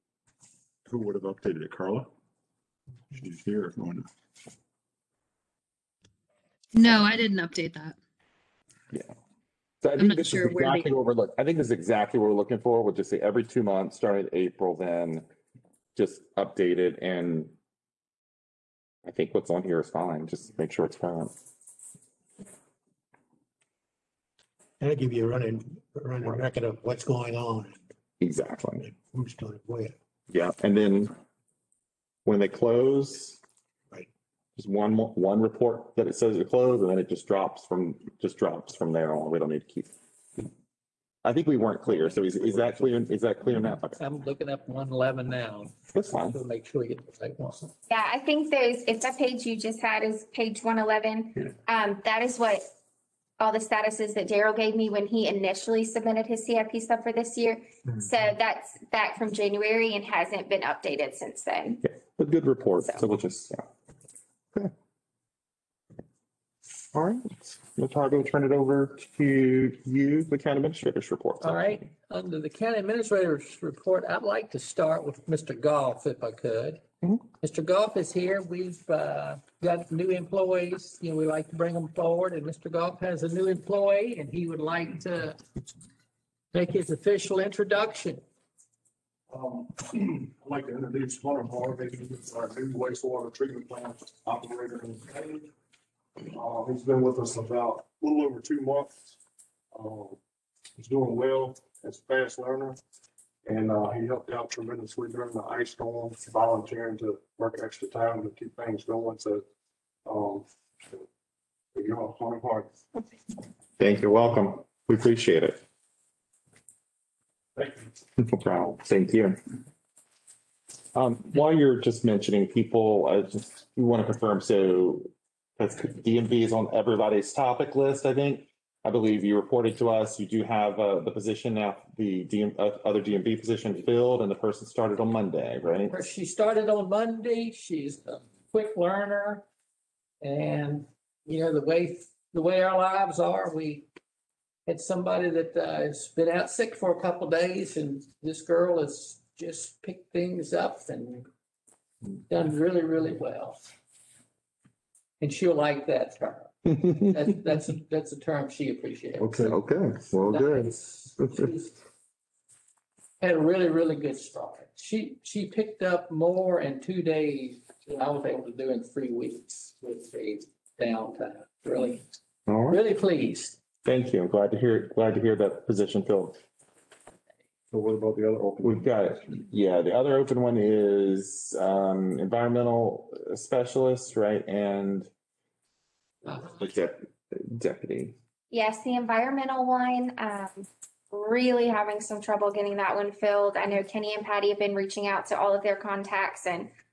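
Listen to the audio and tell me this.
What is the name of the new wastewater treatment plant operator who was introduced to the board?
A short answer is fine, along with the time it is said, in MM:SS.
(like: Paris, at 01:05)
Hunter Harvey, at 01:31.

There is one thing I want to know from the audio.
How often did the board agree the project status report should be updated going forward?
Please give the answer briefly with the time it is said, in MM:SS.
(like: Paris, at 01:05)
Every two months, at 00:13.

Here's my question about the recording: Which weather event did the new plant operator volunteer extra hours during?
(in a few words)
Ice storm.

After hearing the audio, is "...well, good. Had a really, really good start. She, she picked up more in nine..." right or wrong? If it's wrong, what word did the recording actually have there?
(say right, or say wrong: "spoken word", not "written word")
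wrong: "two", not "nine".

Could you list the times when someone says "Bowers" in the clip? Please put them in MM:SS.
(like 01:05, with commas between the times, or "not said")
not said.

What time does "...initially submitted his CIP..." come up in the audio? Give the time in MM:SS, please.
00:55.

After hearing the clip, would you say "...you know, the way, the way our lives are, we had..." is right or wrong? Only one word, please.
right.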